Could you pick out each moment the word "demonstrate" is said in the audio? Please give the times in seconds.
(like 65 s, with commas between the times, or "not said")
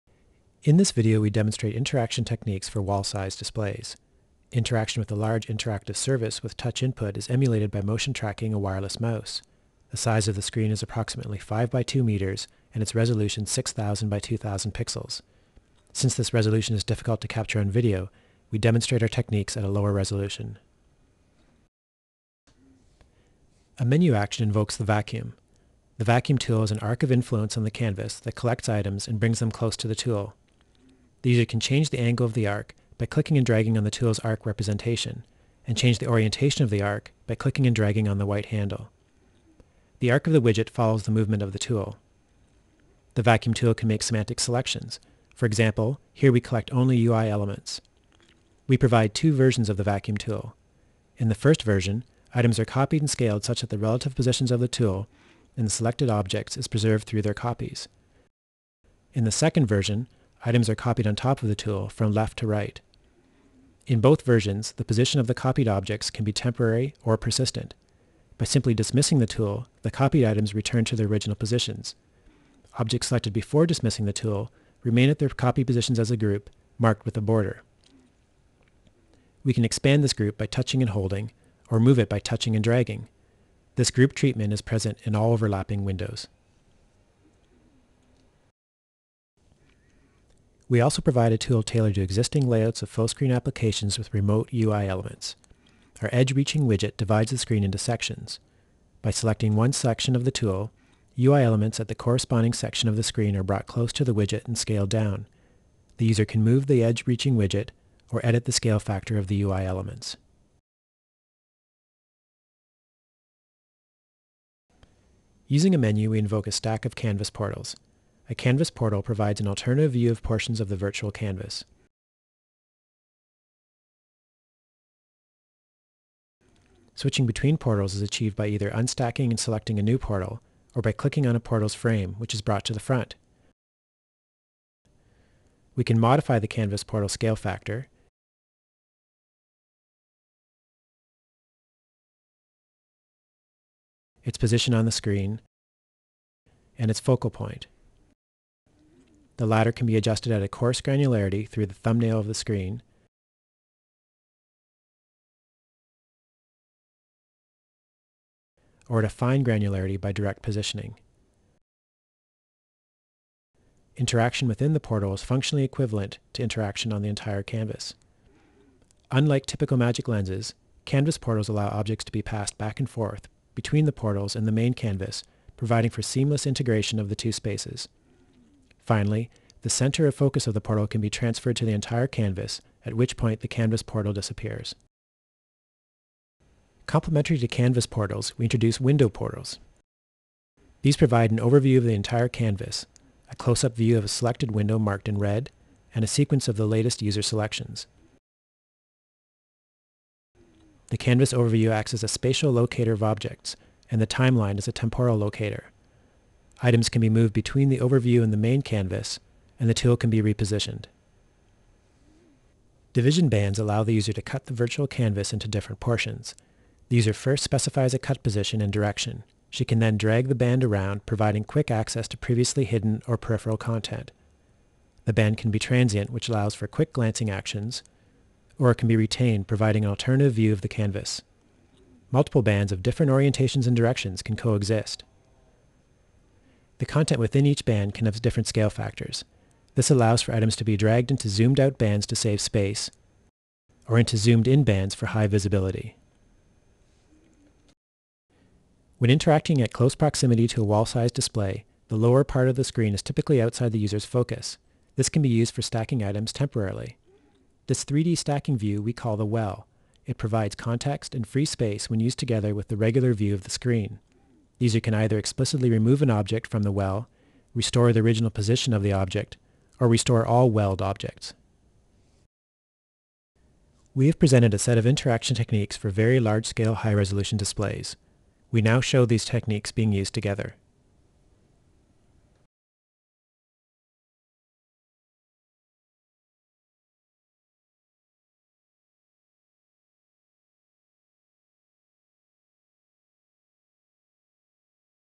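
1 s, 18 s.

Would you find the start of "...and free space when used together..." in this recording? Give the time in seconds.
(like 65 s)
261 s.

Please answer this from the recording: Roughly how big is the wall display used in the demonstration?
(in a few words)
5 by 2 meters.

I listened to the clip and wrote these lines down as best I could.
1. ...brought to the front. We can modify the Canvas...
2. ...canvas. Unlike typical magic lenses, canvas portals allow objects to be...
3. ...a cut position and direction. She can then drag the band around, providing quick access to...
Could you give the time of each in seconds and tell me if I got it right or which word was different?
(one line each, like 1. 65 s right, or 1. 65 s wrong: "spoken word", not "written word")
1. 132 s right
2. 167 s right
3. 217 s right.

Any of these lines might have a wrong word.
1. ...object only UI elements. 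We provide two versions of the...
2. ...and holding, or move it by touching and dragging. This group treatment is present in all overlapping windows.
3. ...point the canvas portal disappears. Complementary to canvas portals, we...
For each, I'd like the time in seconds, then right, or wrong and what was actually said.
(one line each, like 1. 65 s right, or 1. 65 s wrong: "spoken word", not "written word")
1. 46 s wrong: "collect", not "object"
2. 80 s right
3. 183 s right.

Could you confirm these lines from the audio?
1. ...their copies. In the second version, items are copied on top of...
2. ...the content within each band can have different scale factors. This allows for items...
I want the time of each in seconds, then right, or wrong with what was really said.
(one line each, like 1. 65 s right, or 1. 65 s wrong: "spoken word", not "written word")
1. 57 s right
2. 236 s right.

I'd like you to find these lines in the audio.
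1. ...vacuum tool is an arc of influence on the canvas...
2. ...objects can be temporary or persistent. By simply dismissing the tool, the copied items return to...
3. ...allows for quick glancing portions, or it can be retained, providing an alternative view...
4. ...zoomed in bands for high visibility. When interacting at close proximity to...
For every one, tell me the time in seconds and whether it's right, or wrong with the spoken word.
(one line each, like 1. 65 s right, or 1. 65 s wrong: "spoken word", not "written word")
1. 26 s right
2. 65 s right
3. 226 s wrong: "actions", not "portions"
4. 244 s right.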